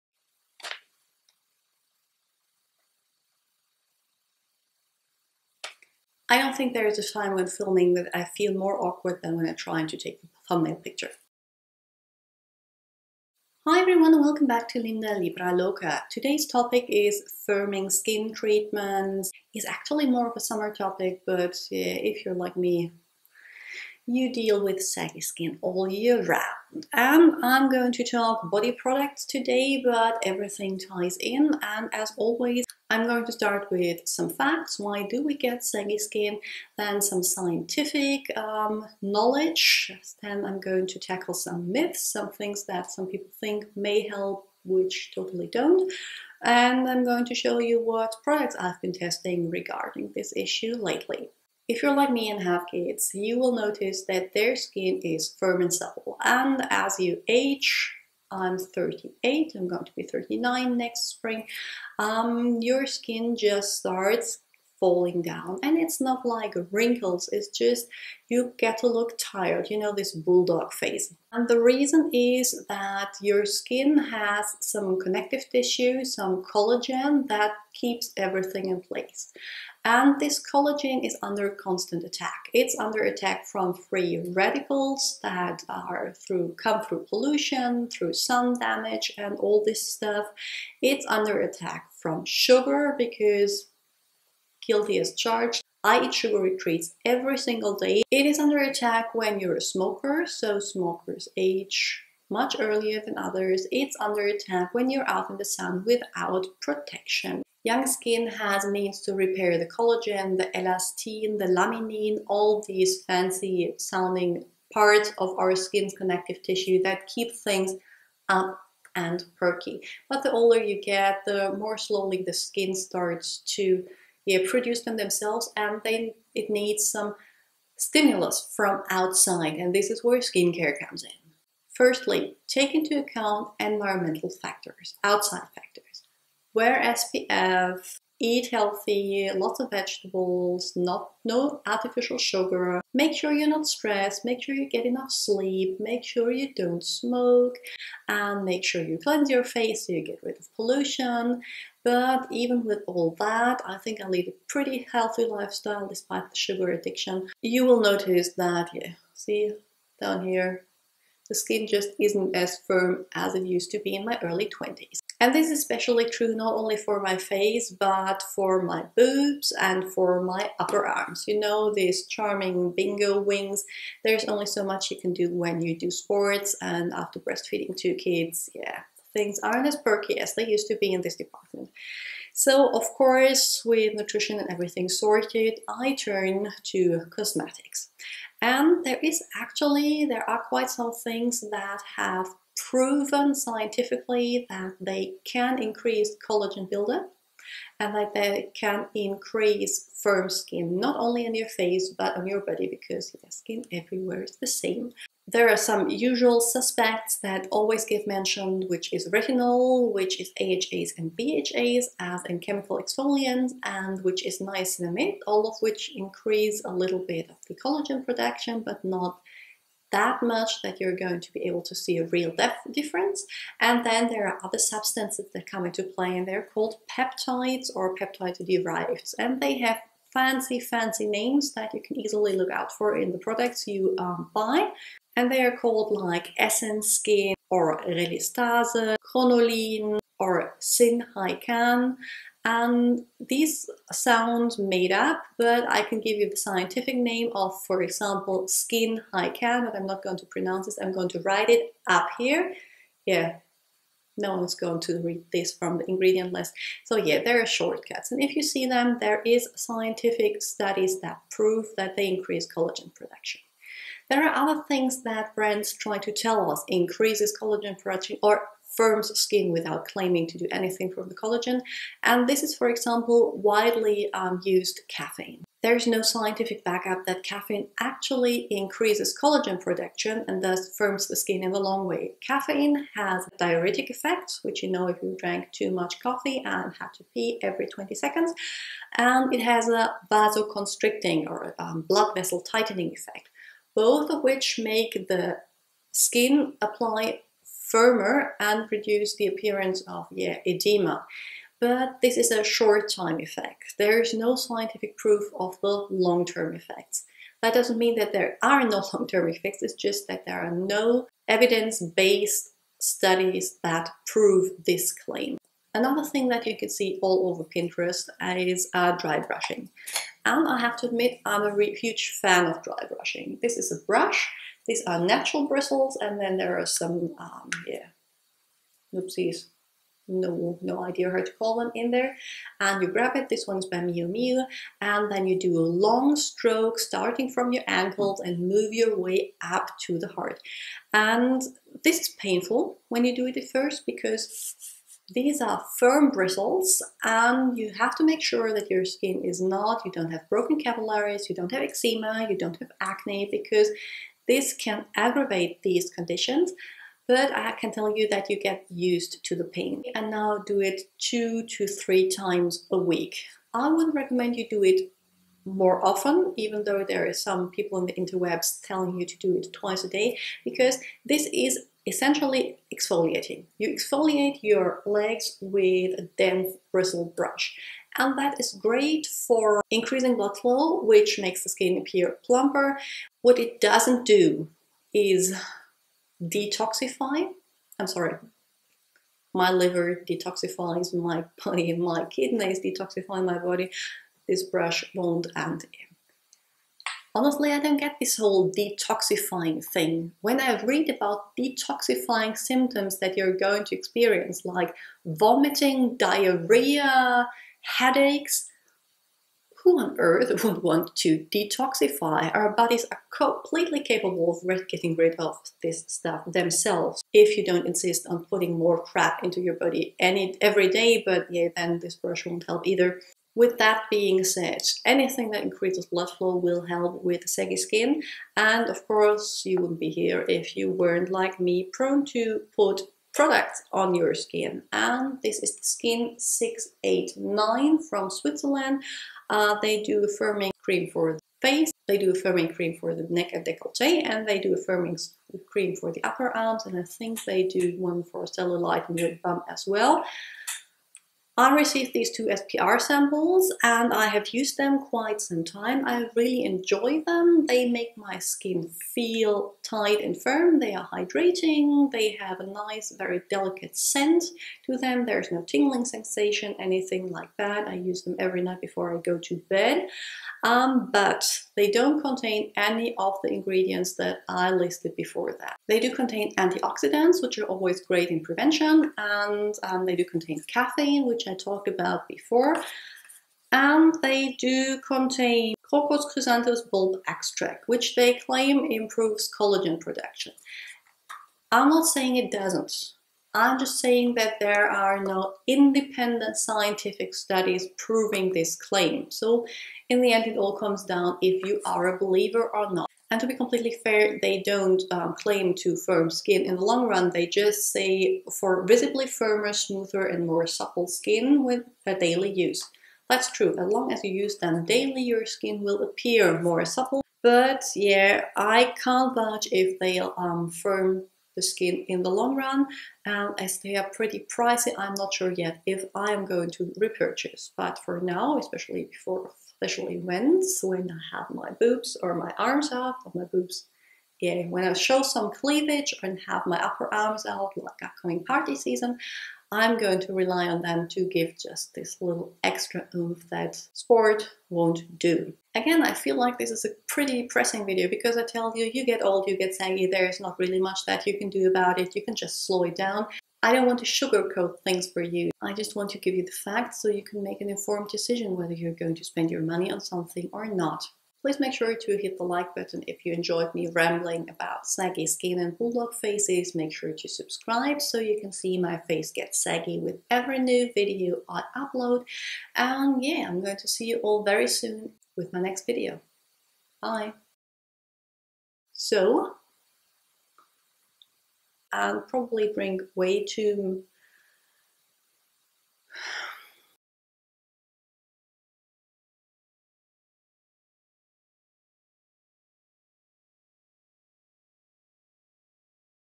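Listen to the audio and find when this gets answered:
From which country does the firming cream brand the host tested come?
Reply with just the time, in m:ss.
7:18.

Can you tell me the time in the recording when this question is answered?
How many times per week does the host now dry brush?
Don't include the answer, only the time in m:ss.
6:00.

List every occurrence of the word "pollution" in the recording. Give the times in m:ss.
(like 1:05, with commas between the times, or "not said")
1:27, 2:30.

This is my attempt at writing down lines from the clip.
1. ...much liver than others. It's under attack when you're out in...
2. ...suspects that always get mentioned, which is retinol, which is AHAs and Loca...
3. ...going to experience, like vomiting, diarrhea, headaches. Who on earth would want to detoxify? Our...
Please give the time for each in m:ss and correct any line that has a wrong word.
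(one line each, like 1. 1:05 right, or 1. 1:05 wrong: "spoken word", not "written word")
1. 1:42 wrong: "earlier", not "liver"
2. 3:26 wrong: "BHAs", not "Loca"
3. 6:43 right.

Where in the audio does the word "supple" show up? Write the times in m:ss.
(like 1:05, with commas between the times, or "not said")
0:55, 8:30, 8:36.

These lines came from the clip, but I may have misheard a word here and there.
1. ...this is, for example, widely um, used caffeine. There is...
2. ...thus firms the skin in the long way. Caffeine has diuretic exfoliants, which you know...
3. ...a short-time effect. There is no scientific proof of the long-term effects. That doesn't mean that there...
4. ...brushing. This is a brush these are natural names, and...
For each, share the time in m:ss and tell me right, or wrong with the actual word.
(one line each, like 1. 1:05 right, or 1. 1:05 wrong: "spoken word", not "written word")
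1. 4:32 right
2. 4:40 wrong: "effects", not "exfoliants"
3. 5:02 right
4. 5:22 wrong: "bristles", not "names".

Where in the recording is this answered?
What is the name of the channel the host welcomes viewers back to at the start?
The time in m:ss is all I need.
0:14.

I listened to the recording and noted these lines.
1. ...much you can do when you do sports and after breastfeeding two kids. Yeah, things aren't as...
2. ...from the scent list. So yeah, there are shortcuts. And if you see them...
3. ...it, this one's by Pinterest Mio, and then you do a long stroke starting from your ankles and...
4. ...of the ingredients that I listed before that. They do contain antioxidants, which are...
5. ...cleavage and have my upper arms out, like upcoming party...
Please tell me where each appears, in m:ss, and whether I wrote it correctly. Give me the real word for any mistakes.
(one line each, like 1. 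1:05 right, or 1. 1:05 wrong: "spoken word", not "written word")
1. 2:54 right
2. 4:15 wrong: "ingredient", not "scent"
3. 5:33 wrong: "Mio", not "Pinterest"
4. 7:52 right
5. 8:55 right.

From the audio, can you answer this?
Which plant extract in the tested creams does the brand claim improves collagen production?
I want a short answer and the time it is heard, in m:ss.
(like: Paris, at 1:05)
Crocus chrysanthus bulb extract, at 8:05.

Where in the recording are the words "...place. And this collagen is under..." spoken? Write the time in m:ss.
1:18.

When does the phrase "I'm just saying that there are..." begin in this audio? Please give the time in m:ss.
8:13.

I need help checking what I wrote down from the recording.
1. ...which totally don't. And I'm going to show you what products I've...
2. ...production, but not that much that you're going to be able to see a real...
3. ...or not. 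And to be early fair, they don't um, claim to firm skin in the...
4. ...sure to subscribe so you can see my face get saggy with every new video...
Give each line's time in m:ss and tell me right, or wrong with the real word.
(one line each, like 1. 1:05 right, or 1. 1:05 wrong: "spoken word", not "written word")
1. 0:44 right
2. 3:38 right
3. 8:22 wrong: "completely", not "early"
4. 9:26 right.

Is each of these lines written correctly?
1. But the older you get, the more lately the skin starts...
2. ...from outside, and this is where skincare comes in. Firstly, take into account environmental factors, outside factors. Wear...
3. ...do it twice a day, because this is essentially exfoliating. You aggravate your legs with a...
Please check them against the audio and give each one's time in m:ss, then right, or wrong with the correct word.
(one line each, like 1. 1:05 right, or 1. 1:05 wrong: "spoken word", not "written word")
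1. 2:00 wrong: "slowly", not "lately"
2. 2:08 right
3. 6:09 wrong: "exfoliate", not "aggravate".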